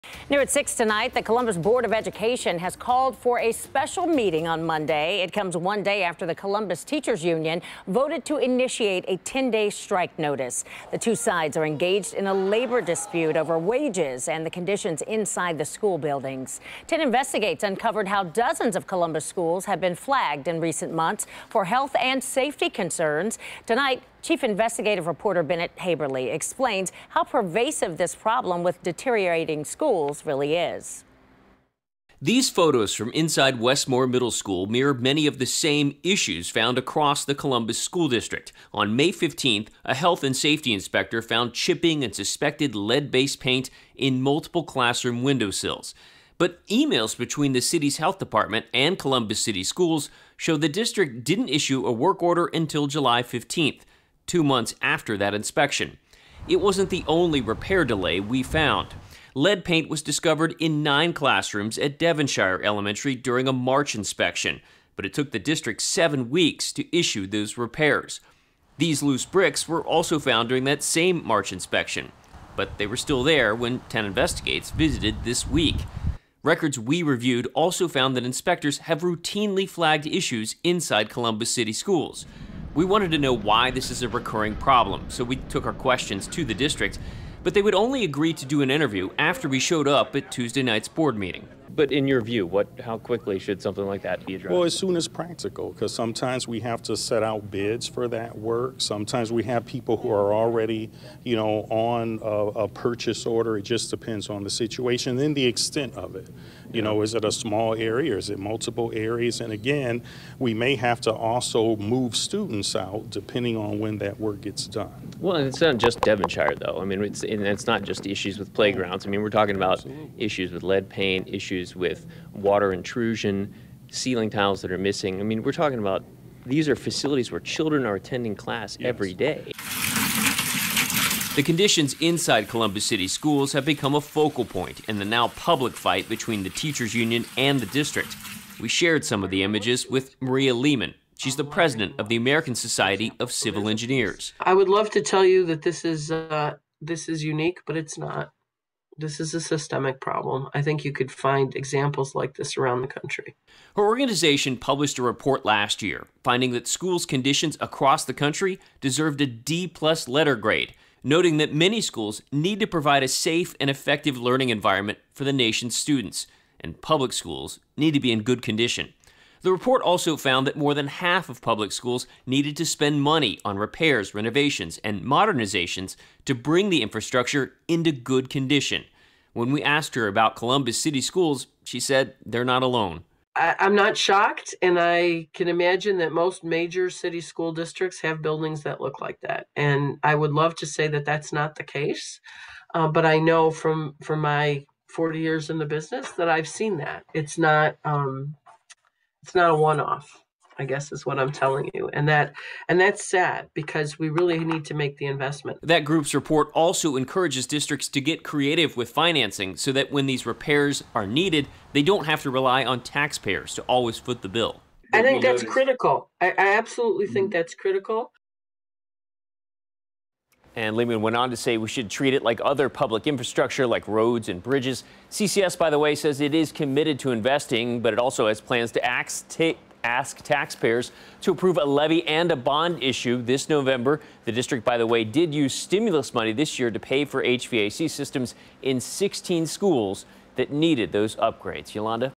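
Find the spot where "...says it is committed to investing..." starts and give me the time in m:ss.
3:45.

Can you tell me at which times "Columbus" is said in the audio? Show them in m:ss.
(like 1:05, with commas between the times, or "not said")
0:01, 0:06, 0:18, 0:37, 0:48, 1:21, 2:12, 3:00.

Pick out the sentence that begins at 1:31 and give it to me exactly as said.
But in your view, what, how quickly should something like that be addressed?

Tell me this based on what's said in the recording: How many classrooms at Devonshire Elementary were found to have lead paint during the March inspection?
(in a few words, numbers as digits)
9.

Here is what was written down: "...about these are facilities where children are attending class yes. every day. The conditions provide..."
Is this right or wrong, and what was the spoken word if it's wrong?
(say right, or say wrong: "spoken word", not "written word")
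wrong: "inside", not "provide".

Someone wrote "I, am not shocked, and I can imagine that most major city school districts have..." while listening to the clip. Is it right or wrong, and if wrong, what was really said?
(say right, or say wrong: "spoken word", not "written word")
right.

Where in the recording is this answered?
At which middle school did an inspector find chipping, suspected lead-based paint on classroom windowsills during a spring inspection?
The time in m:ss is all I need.
0:33.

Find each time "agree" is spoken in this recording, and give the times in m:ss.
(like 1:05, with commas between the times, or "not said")
1:28.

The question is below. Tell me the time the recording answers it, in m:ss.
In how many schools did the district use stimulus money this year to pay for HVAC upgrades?
3:58.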